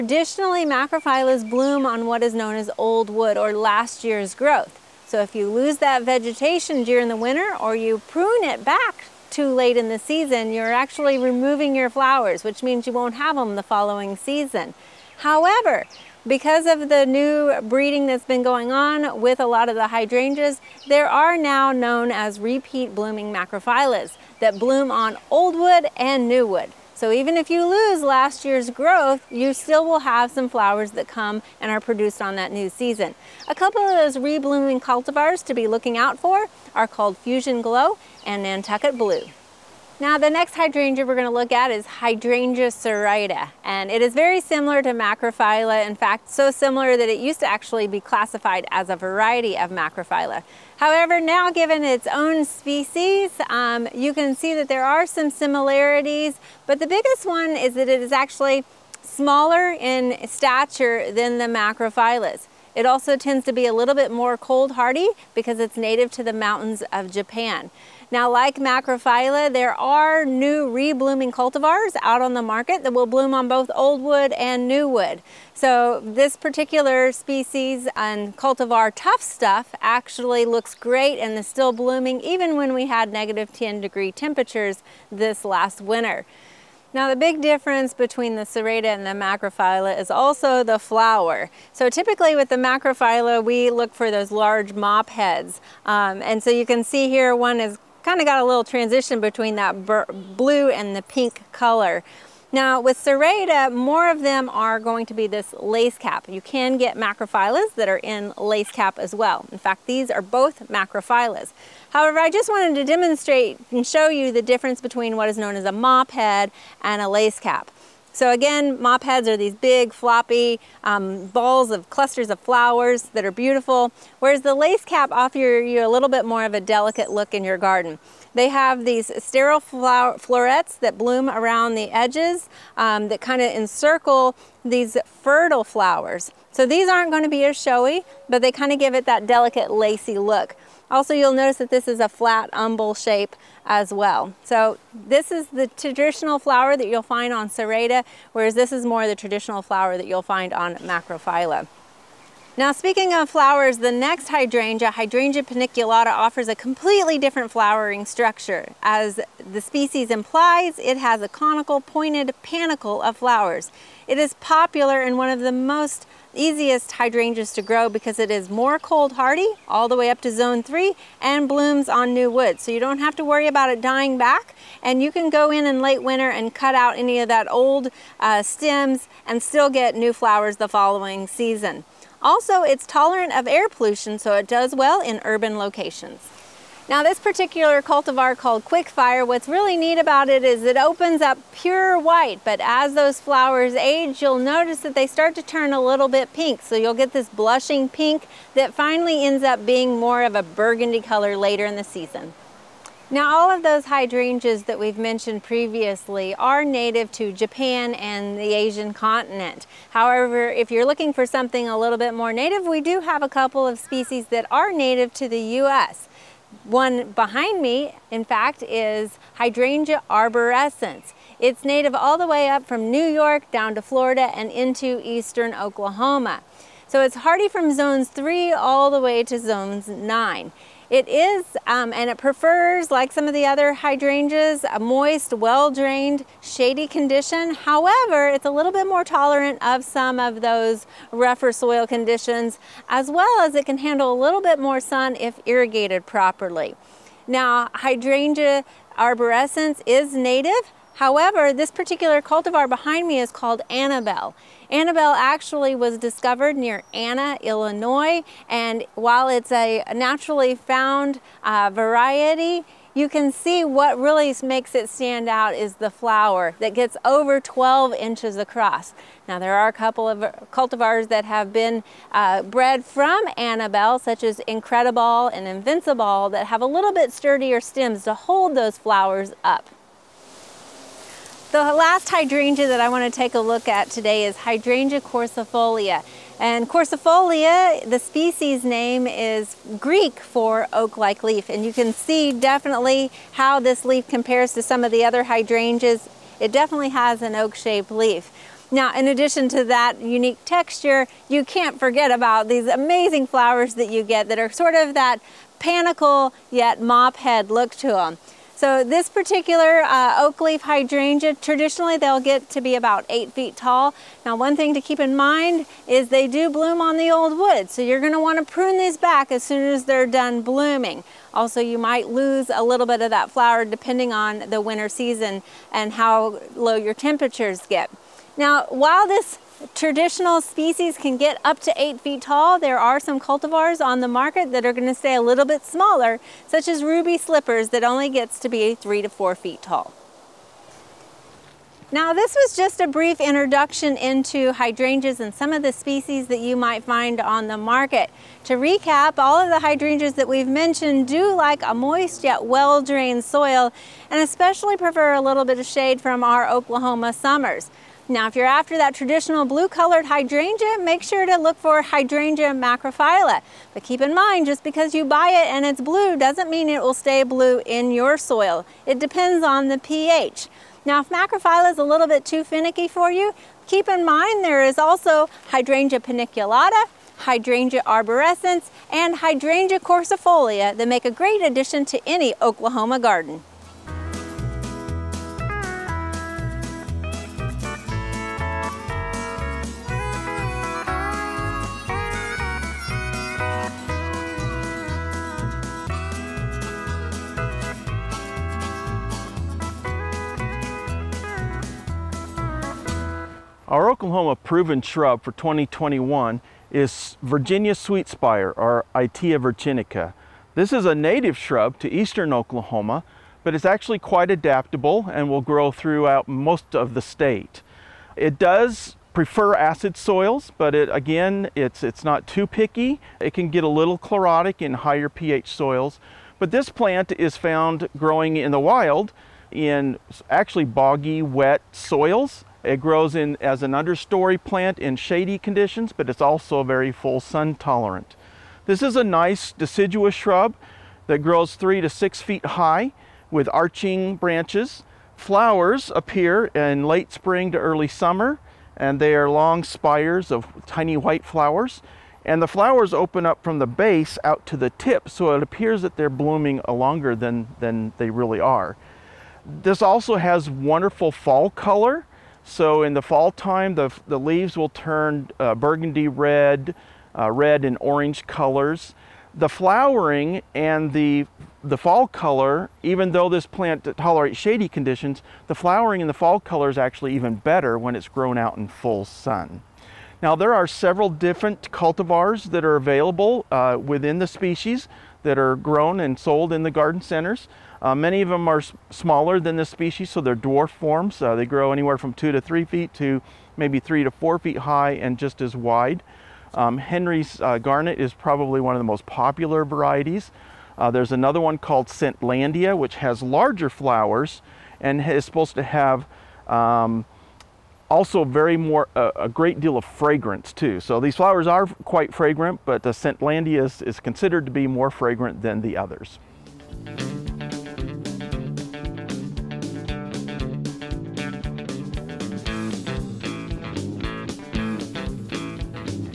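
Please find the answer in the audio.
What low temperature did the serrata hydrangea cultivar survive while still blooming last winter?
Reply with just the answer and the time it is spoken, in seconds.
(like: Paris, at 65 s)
-10 degrees, at 83 s.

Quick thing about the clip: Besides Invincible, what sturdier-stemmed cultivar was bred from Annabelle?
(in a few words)
Incredible.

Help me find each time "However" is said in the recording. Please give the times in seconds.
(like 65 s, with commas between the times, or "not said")
15 s, 50 s, 111 s, 209 s, 237 s, 250 s.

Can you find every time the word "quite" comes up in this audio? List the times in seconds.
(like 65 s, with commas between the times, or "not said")
413 s, 511 s.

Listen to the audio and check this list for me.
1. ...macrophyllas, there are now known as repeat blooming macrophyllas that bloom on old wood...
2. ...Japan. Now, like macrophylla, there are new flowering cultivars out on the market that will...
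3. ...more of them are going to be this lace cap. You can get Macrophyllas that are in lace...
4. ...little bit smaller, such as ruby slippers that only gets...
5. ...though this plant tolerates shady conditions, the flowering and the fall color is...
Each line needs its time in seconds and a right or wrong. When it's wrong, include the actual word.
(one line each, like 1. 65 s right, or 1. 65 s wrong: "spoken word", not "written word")
1. 19 s wrong: "hydrangeas", not "macrophyllas"
2. 67 s wrong: "reblooming", not "flowering"
3. 103 s right
4. 335 s right
5. 473 s right.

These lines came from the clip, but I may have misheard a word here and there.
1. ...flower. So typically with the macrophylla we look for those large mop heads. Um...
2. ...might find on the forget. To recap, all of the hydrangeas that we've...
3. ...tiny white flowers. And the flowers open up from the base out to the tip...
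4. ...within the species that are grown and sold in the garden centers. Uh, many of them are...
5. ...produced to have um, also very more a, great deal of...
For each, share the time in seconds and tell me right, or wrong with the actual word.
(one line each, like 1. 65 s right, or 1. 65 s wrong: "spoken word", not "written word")
1. 90 s right
2. 346 s wrong: "market", not "forget"
3. 450 s right
4. 483 s right
5. 505 s wrong: "supposed", not "produced".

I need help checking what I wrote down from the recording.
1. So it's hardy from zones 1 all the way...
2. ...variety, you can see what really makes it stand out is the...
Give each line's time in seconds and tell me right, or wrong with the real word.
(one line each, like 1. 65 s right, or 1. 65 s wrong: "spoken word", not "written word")
1. 226 s wrong: "3", not "1"
2. 261 s right.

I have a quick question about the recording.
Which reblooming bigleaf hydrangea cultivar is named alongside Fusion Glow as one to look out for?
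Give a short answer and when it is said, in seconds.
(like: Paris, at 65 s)
Nantucket Blue, at 38 s.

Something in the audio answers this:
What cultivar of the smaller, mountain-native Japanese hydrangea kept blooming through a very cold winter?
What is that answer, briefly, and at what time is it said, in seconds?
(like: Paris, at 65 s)
Tough Stuff, at 78 s.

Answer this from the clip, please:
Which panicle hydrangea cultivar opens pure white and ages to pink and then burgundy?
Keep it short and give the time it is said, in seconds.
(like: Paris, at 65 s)
Quickfire, at 188 s.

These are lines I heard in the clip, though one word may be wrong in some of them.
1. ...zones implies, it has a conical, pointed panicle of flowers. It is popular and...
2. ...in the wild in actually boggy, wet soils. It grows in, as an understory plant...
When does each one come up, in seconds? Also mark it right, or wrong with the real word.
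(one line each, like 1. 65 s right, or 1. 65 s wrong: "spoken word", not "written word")
1. 159 s wrong: "species", not "zones"
2. 428 s right.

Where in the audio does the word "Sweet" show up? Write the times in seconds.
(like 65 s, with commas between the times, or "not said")
407 s.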